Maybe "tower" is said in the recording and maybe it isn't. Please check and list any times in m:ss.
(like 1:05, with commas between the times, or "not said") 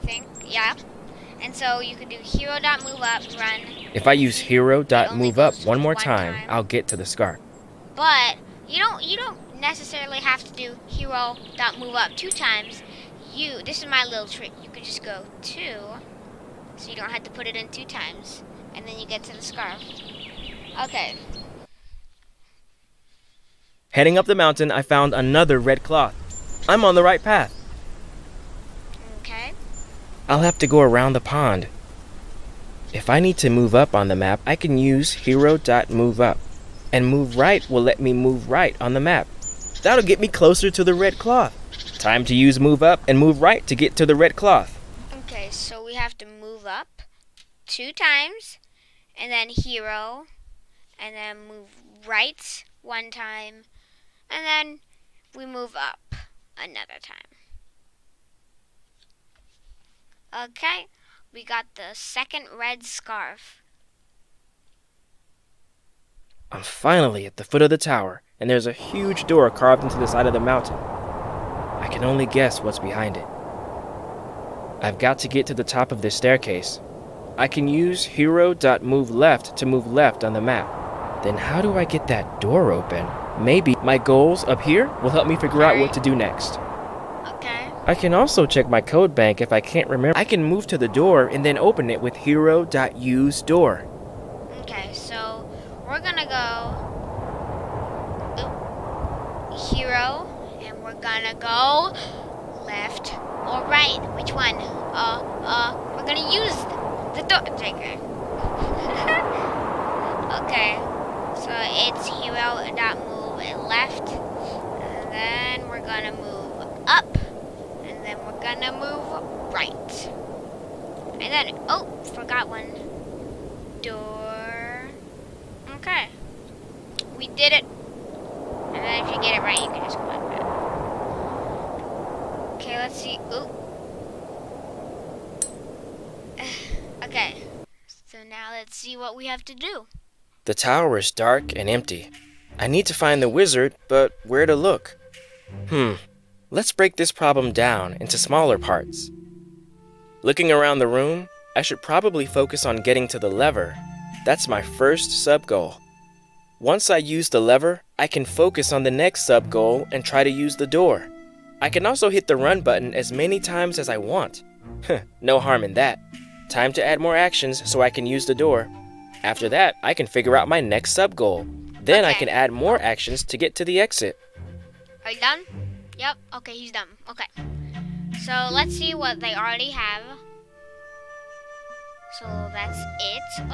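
1:07, 2:20.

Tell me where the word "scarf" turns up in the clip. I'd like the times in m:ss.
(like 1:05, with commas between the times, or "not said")
0:07, 0:19, 1:02.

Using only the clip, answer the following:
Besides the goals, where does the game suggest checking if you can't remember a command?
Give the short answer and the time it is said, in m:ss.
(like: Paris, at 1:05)
code bank, at 1:28.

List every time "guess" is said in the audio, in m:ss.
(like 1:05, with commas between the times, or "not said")
1:12.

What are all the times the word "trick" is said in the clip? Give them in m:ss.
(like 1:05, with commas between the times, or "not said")
0:14.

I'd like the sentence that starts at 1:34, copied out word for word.
Okay, so we're gonna go hero and we're gonna go left or right.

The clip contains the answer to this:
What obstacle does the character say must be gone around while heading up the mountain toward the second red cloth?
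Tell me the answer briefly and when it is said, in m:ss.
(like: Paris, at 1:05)
the pond, at 0:31.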